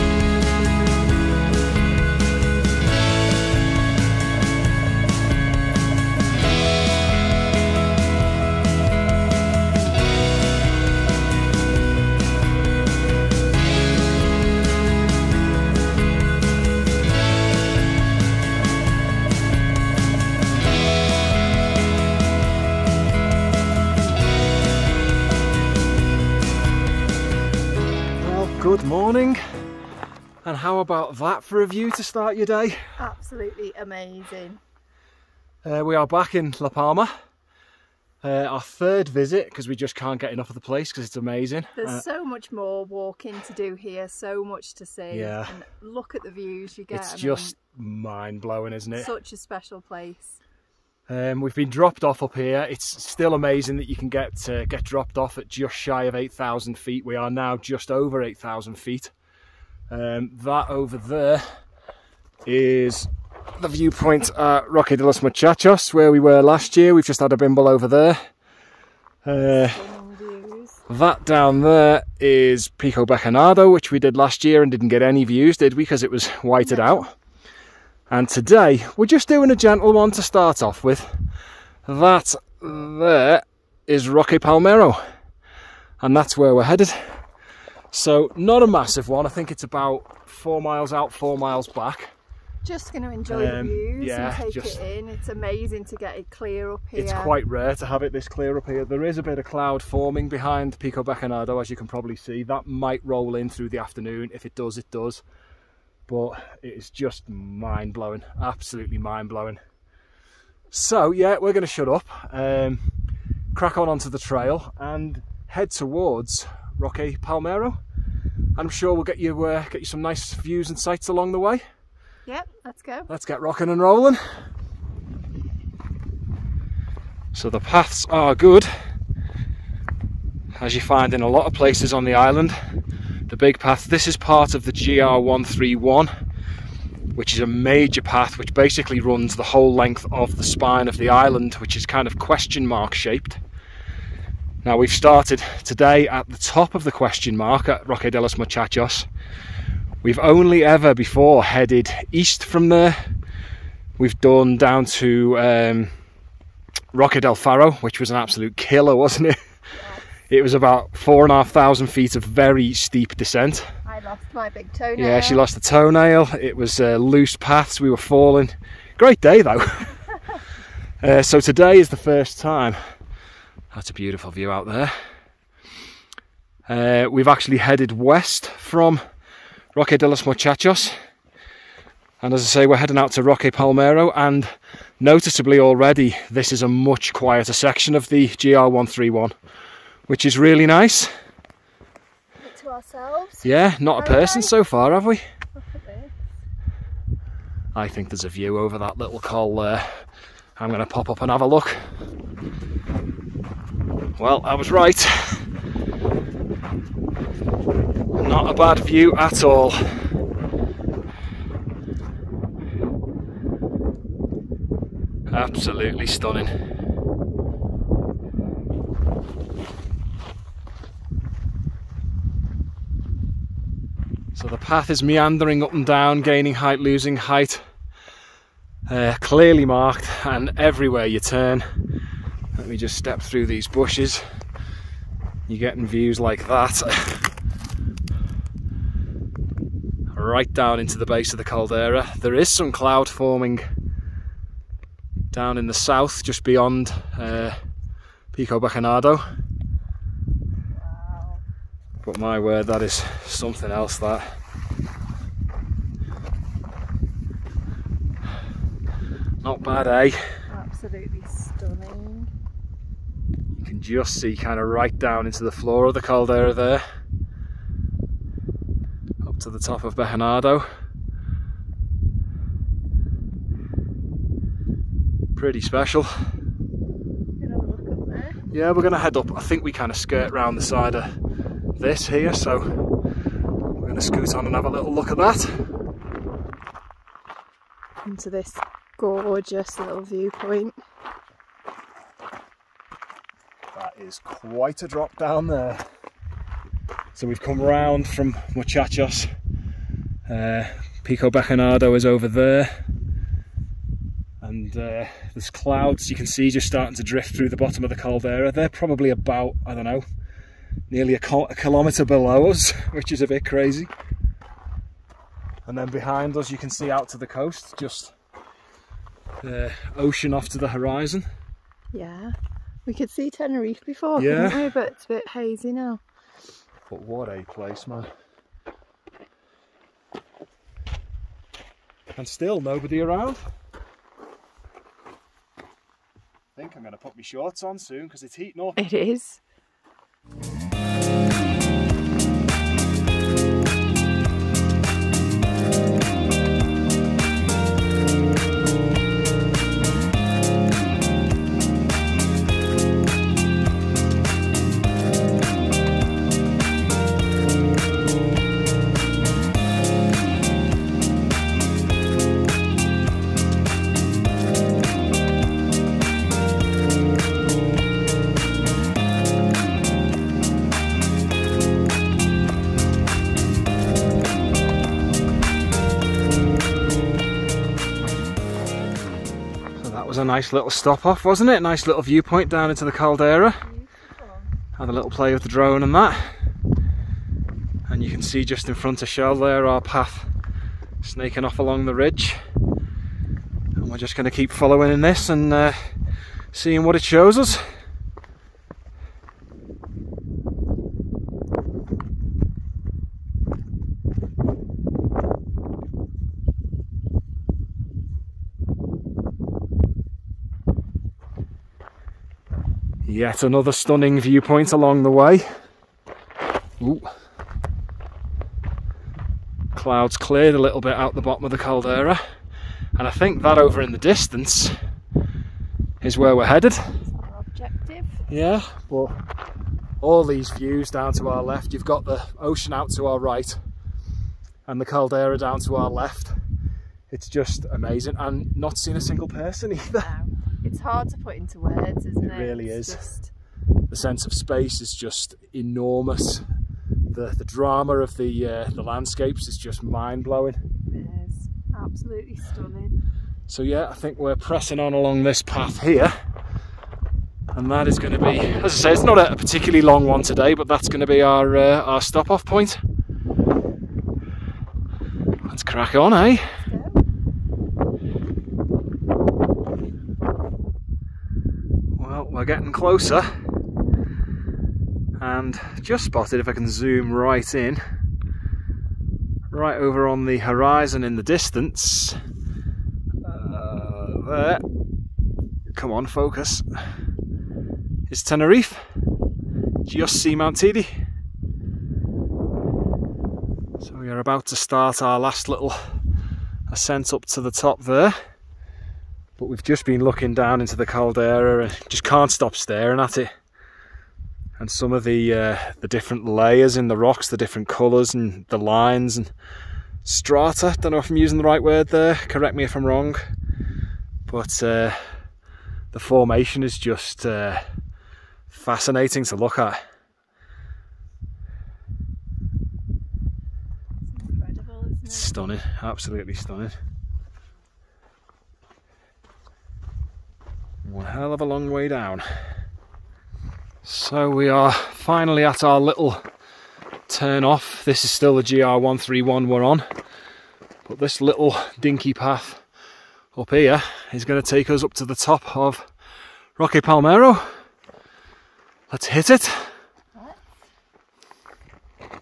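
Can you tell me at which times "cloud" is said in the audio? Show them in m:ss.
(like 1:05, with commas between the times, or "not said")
1:39, 4:02, 5:05, 6:59.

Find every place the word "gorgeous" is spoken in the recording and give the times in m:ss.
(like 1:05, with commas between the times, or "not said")
4:48.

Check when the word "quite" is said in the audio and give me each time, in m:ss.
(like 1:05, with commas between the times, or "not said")
1:37, 4:54.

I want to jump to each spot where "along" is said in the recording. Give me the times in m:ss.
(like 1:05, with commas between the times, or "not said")
2:01, 6:31, 6:54, 7:34.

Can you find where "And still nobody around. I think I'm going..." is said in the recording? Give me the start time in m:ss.
5:32.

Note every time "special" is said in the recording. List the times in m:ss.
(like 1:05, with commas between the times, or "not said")
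0:49, 4:35.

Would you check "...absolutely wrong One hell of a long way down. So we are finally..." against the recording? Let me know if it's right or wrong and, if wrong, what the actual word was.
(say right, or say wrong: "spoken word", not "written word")
wrong: "stunning", not "wrong".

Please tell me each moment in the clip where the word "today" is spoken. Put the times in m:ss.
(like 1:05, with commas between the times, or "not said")
1:18, 2:25, 2:51, 7:40.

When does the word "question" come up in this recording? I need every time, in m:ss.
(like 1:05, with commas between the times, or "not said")
2:22, 2:26.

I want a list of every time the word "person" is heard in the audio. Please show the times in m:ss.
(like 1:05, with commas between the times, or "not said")
3:14, 7:19.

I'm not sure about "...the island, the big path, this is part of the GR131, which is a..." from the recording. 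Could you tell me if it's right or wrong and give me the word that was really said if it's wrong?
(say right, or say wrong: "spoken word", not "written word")
right.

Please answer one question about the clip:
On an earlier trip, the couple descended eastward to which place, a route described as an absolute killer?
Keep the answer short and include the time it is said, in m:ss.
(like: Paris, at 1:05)
Roque del Faro, at 2:36.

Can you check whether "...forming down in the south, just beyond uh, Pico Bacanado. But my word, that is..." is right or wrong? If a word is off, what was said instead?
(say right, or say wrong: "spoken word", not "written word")
right.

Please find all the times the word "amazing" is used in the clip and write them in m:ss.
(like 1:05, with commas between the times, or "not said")
0:33, 0:41, 0:53, 1:35, 7:17.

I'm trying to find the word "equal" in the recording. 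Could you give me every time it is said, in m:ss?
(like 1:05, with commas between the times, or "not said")
not said.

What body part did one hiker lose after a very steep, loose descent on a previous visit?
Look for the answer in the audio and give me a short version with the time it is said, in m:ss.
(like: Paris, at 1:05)
Big toenail, at 2:44.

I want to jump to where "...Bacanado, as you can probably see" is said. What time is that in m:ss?
1:41.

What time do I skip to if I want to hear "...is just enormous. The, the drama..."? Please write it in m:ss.
7:24.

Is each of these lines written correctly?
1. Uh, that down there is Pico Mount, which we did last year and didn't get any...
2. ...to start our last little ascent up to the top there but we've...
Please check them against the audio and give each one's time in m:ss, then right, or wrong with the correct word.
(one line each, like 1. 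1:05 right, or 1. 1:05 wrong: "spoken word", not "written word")
1. 1:09 wrong: "Bacanado", not "Mount"
2. 8:14 right.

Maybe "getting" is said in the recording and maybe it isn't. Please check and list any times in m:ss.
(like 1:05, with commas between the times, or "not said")
3:55, 7:52.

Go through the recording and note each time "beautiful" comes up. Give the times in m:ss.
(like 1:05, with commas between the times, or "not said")
2:53.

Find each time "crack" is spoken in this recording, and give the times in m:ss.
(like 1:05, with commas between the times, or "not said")
1:53, 7:45.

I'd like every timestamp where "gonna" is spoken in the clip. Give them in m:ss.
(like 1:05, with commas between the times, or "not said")
4:38, 4:43.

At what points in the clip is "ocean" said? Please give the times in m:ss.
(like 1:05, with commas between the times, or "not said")
5:19, 7:12.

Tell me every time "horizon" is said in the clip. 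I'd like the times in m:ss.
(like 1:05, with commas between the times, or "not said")
5:20, 8:00.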